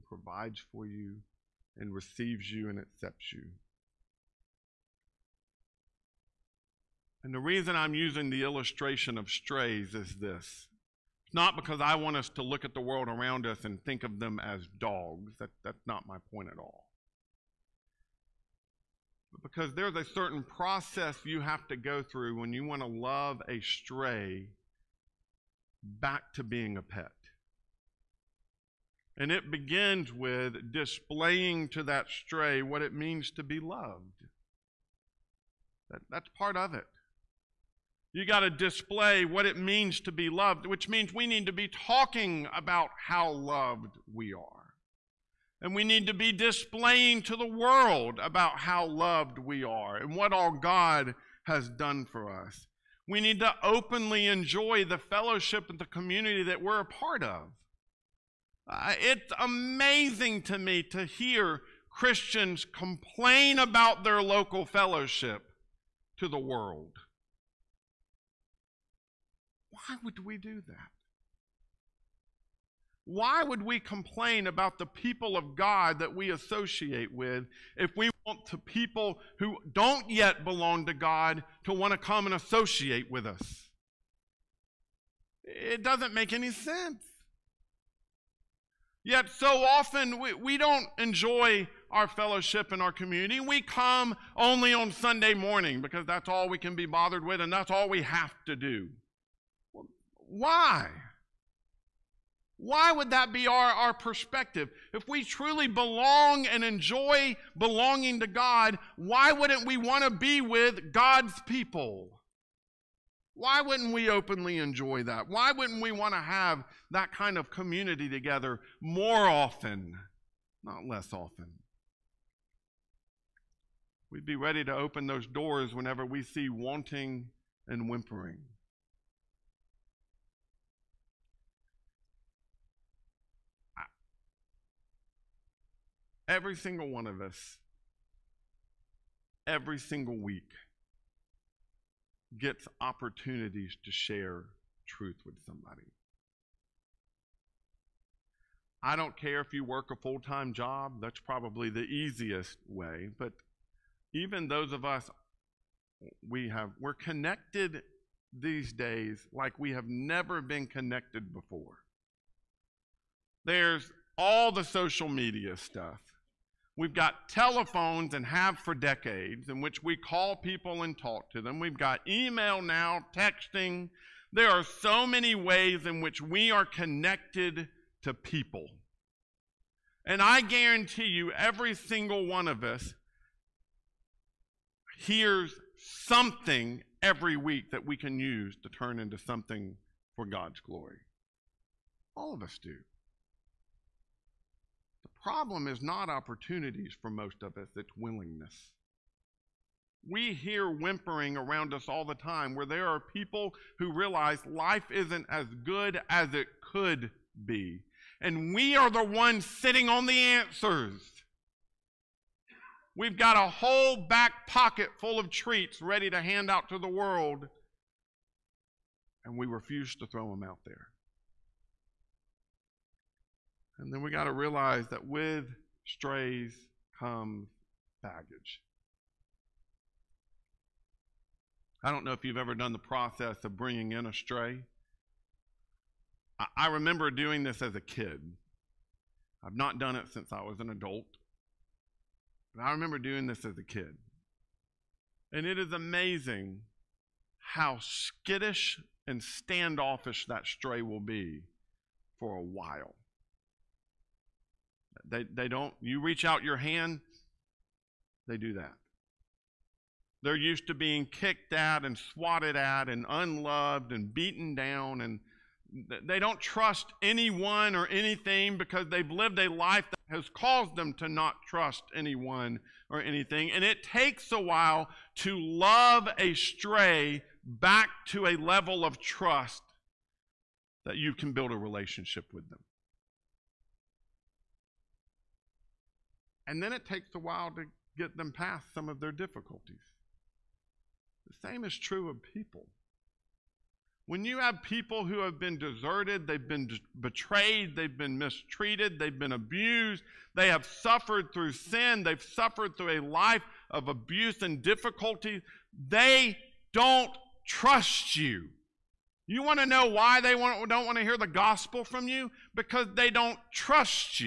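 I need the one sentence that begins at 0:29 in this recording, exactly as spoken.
And it begins with displaying to that stray what it means to be loved.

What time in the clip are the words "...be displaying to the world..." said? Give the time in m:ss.
0:46.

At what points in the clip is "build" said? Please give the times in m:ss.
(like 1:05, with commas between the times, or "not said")
4:41.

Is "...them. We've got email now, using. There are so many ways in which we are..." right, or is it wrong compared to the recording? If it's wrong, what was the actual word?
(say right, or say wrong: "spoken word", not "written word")
wrong: "texting", not "using".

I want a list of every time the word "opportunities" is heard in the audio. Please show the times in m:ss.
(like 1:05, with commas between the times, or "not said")
2:22, 3:16.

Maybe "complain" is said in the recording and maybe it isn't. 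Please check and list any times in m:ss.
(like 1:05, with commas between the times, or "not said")
1:02, 1:13.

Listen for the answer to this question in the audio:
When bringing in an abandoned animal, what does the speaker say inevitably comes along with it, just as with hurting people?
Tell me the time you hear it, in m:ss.
3:48.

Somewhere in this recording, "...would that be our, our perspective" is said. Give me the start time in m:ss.
1:42.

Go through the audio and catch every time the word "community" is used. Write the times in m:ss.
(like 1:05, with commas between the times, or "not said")
0:55, 1:32, 1:57.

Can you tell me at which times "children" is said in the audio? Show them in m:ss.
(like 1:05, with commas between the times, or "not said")
not said.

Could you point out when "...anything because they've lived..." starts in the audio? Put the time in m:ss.
4:27.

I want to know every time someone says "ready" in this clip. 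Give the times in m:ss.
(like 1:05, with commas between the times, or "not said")
2:04, 3:35.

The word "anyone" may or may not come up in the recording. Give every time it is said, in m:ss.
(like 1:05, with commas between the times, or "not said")
4:27, 4:31.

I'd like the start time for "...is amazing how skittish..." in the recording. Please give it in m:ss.
4:05.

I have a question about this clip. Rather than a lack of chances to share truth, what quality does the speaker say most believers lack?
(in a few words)
willingness.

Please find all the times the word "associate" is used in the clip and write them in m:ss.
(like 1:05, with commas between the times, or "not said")
1:16, 1:22.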